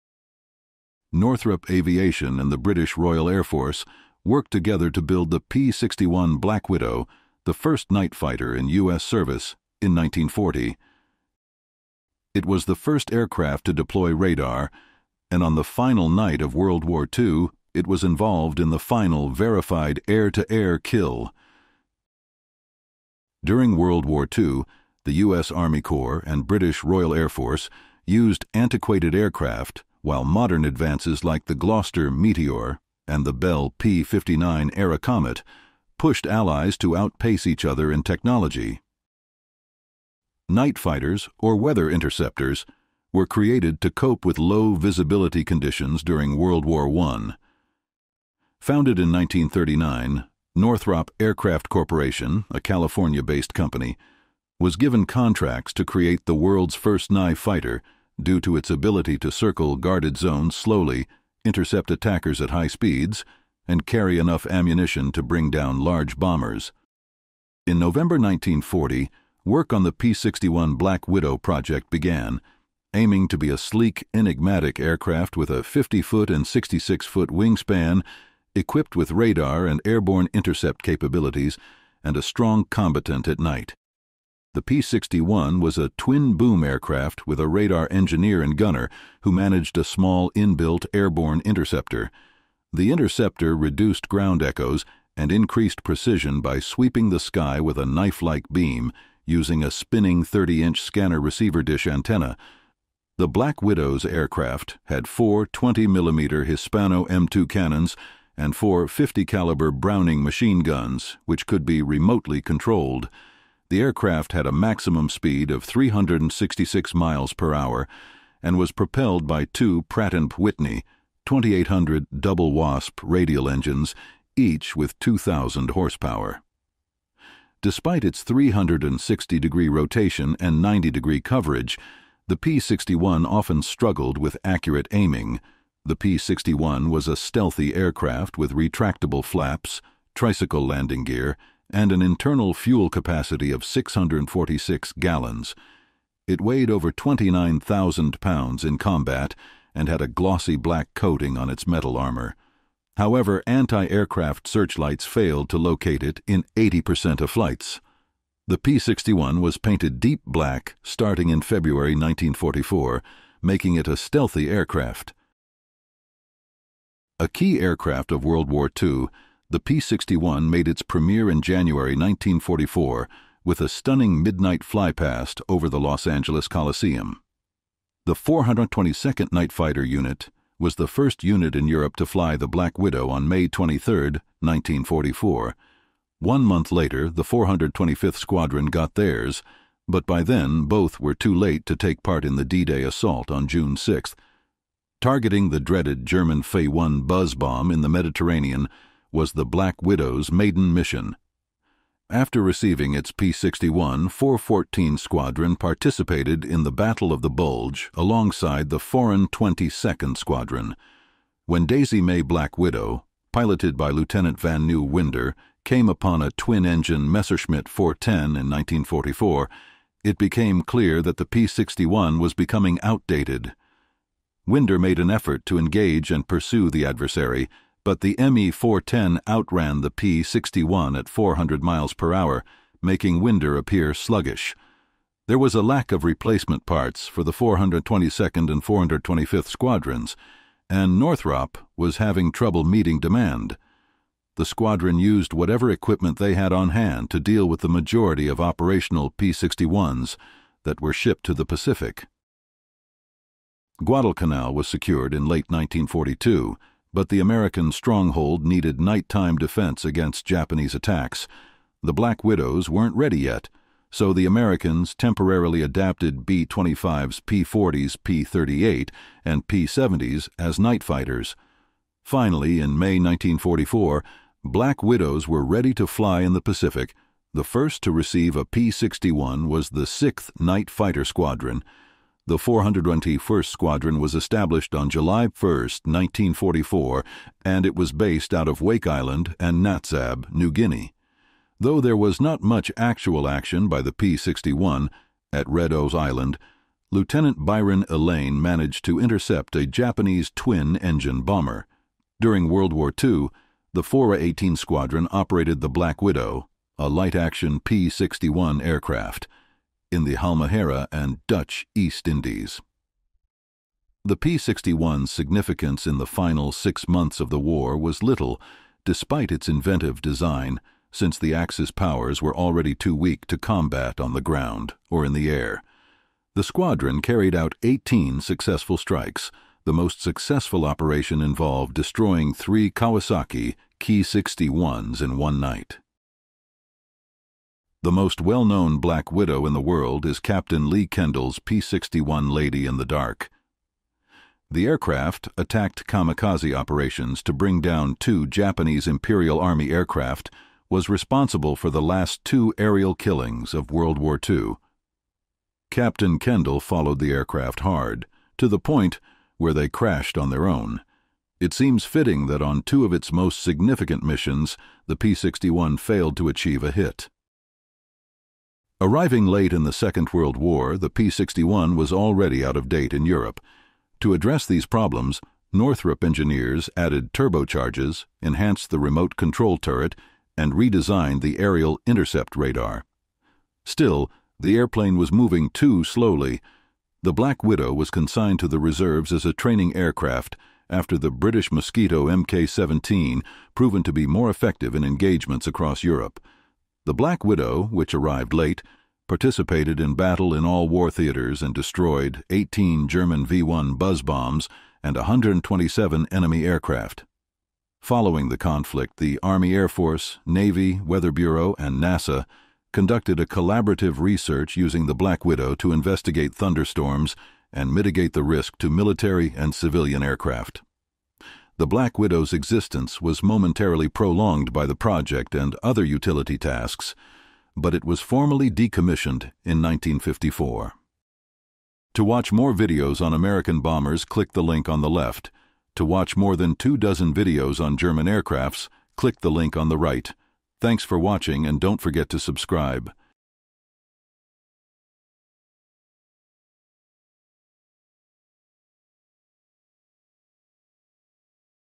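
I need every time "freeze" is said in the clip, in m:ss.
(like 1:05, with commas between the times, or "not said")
not said.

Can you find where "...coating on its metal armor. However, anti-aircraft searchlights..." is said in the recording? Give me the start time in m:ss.
2:30.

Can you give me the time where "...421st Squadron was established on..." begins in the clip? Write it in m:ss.
4:42.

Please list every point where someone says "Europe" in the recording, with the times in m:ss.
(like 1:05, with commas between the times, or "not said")
3:01, 6:13, 6:35.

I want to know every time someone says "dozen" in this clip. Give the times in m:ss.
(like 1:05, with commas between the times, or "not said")
7:16.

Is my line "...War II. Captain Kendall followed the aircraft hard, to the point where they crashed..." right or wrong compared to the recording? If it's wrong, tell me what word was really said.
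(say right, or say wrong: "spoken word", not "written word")
right.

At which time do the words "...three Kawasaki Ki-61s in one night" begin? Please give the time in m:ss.
5:32.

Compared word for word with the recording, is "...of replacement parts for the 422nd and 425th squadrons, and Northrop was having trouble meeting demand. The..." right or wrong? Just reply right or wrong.
right.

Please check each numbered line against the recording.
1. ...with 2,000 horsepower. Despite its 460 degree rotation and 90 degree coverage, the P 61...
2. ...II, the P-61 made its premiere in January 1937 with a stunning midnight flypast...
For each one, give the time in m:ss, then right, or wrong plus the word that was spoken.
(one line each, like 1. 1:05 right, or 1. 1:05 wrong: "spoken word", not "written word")
1. 2:04 wrong: "360", not "460"
2. 2:48 wrong: "1944", not "1937".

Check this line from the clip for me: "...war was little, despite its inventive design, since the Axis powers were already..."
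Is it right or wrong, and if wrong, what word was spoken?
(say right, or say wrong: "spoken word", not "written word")
right.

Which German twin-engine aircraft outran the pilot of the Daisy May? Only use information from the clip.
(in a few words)
Messerschmitt 410.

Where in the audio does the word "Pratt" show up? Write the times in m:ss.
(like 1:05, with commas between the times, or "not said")
1:59.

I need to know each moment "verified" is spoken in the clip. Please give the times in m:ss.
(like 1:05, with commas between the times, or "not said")
0:19.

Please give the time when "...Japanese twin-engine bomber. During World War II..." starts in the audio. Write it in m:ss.
4:59.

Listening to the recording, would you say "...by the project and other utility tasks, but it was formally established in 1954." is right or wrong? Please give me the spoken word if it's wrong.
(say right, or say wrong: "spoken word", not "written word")
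wrong: "decommissioned", not "established".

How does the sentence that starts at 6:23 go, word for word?
Still, the airplane was moving too slowly.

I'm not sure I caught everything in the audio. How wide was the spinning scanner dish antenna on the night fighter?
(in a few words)
30 inches.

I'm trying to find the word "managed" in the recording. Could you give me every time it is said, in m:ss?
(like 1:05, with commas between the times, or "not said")
1:29, 4:58.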